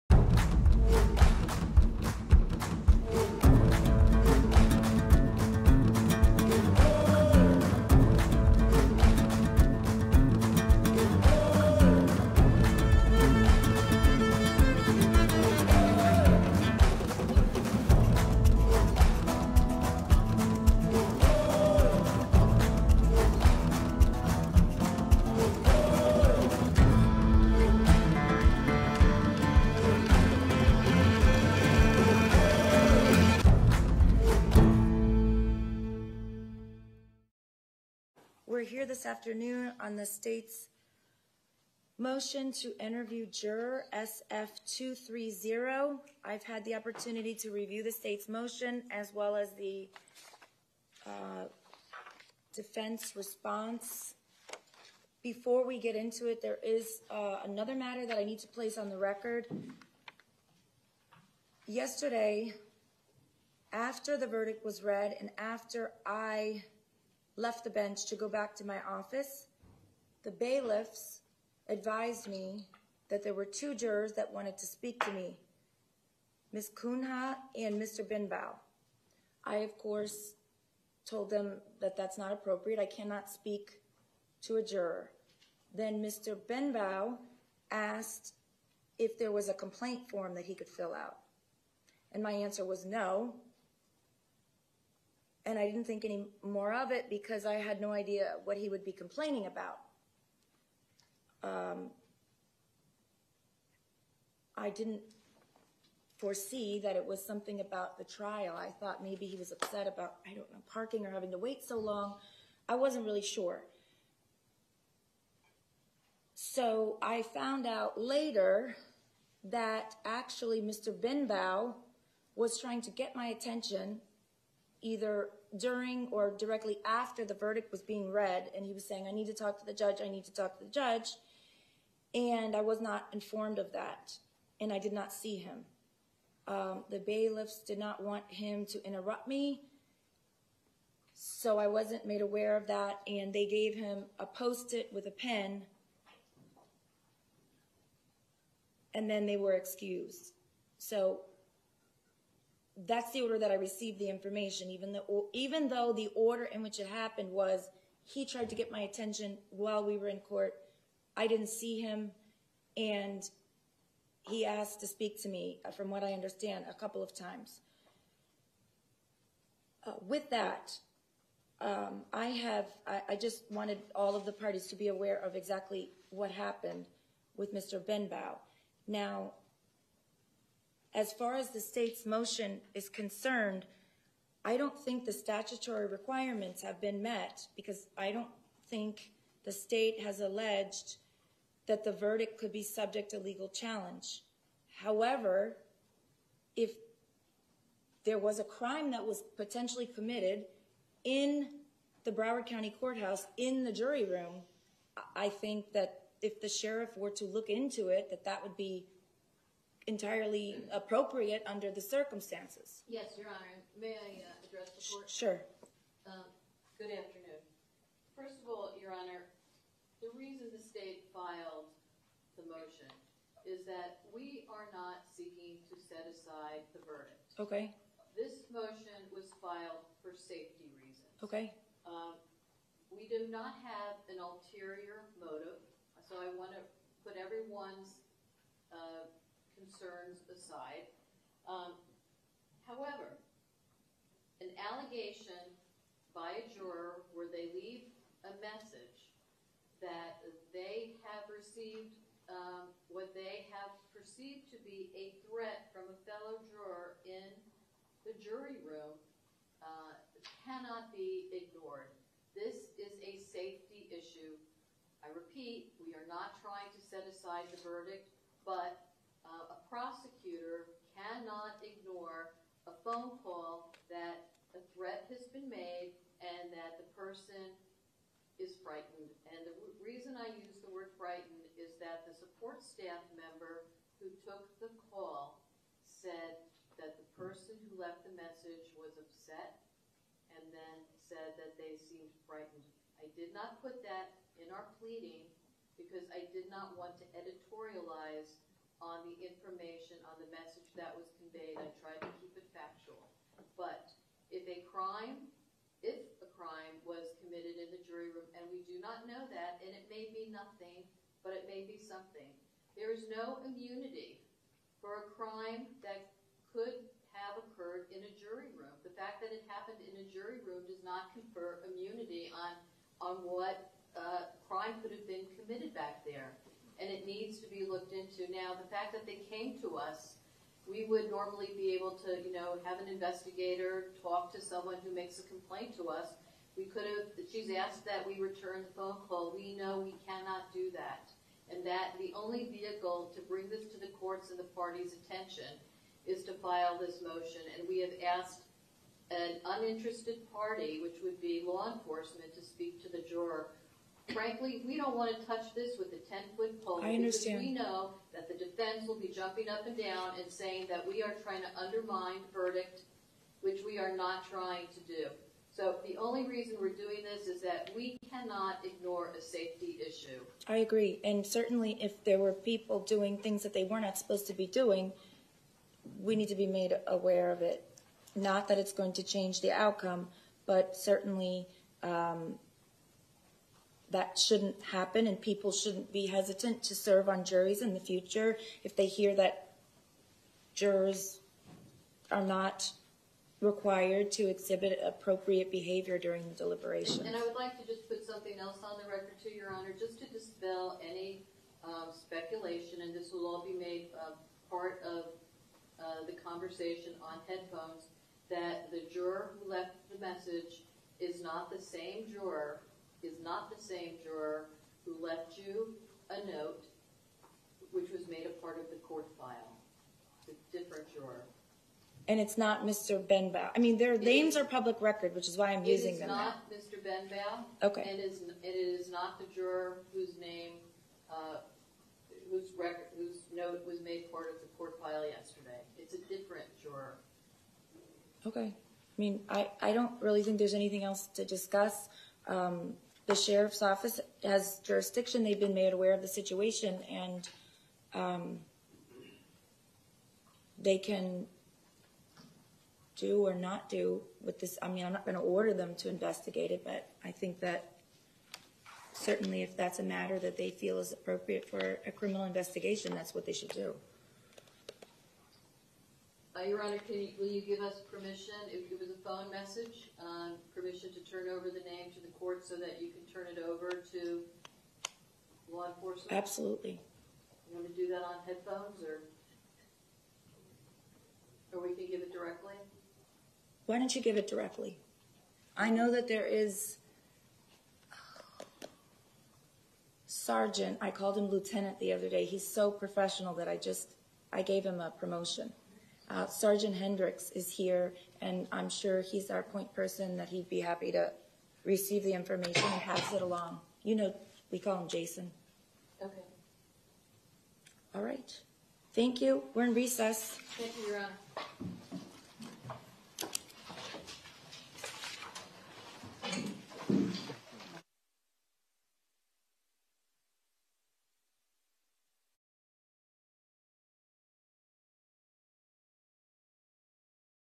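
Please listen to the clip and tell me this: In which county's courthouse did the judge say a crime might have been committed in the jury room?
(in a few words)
Broward County.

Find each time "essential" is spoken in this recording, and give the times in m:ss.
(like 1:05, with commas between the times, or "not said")
not said.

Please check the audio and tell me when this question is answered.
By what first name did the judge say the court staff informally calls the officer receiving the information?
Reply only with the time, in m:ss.
8:24.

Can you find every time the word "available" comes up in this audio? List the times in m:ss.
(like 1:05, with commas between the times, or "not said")
not said.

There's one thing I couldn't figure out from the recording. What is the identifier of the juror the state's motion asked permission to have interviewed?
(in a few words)
SF230.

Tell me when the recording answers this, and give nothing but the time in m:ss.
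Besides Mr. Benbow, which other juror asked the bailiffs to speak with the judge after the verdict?
1:16.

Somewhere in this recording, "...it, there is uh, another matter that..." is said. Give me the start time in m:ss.
0:56.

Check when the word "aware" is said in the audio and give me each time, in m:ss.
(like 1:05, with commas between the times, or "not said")
2:22, 2:54, 6:16, 7:25.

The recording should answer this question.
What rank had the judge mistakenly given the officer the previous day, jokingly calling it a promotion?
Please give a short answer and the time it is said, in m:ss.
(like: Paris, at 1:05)
Lieutenant, at 8:11.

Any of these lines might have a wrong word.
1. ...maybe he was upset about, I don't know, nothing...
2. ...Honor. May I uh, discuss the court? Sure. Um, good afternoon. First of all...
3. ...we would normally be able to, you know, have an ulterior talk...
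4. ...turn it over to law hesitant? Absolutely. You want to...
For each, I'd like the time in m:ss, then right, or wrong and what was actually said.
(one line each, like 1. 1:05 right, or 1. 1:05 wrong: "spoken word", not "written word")
1. 1:49 wrong: "parking", not "nothing"
2. 3:33 wrong: "address", not "discuss"
3. 5:30 wrong: "investigator", not "ulterior"
4. 7:53 wrong: "enforcement", not "hesitant".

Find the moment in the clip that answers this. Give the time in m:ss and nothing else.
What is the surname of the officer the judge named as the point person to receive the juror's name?
8:16.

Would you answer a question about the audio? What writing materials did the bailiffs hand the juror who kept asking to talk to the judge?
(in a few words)
a post-it with a pen.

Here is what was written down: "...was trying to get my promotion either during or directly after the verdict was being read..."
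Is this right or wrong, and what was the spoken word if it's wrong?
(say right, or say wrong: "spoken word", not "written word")
wrong: "attention", not "promotion".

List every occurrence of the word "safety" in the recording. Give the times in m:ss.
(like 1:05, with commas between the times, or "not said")
3:50, 4:23, 6:09.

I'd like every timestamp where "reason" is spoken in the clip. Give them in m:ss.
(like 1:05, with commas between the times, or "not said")
3:40, 3:50, 4:39, 6:06.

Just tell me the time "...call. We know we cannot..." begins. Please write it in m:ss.
5:39.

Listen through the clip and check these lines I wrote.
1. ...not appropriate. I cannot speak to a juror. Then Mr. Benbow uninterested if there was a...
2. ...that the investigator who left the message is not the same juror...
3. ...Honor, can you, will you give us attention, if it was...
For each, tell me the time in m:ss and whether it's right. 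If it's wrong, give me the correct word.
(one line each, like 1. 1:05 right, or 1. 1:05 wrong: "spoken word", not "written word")
1. 1:22 wrong: "asked", not "uninterested"
2. 6:48 wrong: "juror", not "investigator"
3. 7:46 wrong: "permission", not "attention".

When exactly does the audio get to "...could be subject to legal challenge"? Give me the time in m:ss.
3:12.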